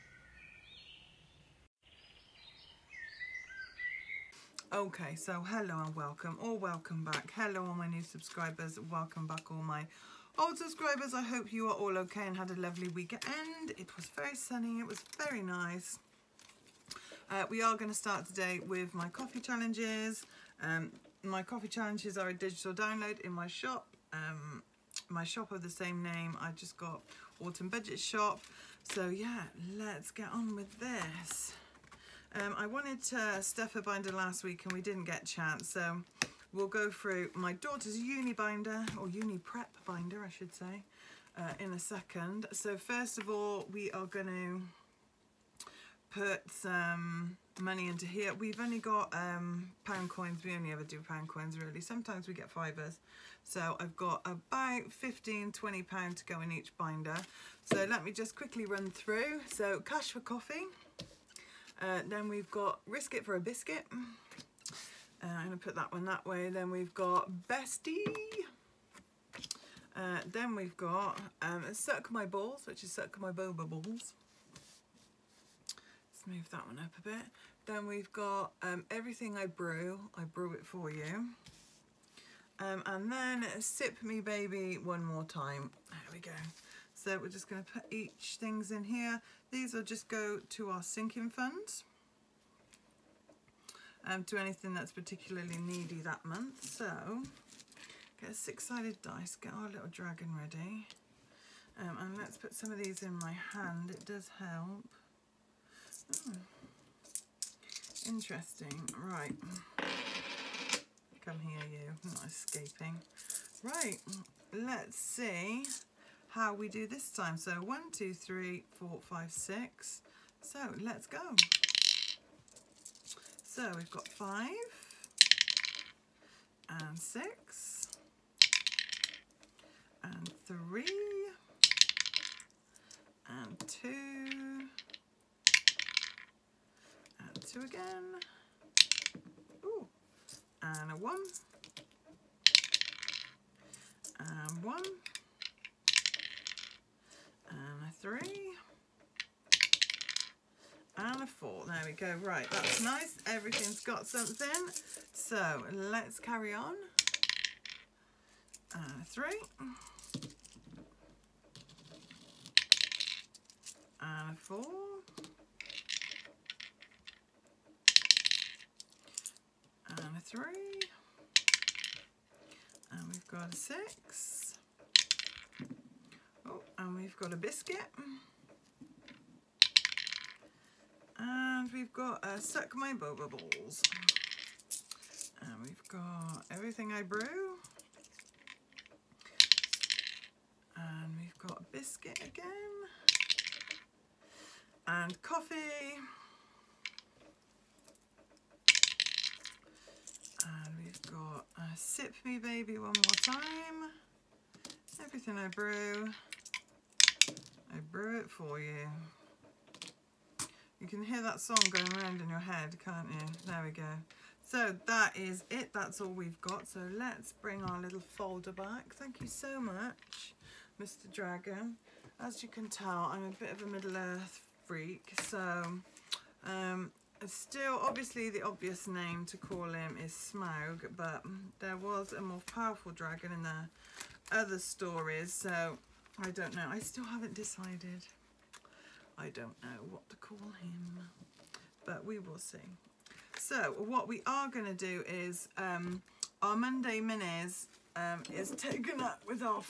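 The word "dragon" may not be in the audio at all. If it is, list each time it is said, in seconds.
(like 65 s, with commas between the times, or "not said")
99 s, 221 s, 232 s.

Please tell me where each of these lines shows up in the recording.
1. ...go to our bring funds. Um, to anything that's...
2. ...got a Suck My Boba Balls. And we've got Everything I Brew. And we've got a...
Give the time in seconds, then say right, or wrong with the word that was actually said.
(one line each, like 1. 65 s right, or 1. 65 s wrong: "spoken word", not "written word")
1. 90 s wrong: "sinking", not "bring"
2. 181 s right.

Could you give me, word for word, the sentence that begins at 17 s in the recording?
Uh, we are going to start today with my coffee challenges.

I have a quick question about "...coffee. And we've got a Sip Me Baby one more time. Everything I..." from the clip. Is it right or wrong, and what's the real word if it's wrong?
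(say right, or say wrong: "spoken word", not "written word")
right.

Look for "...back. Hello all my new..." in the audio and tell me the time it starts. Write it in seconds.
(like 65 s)
7 s.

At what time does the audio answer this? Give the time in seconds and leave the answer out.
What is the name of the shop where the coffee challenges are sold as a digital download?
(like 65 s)
27 s.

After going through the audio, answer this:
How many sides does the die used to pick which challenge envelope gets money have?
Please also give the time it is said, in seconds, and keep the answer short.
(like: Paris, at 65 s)
6, at 98 s.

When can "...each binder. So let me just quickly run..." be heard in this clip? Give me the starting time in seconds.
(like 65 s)
56 s.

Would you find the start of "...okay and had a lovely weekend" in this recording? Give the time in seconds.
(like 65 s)
11 s.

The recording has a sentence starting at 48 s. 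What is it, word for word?
We've only got um, pound coins.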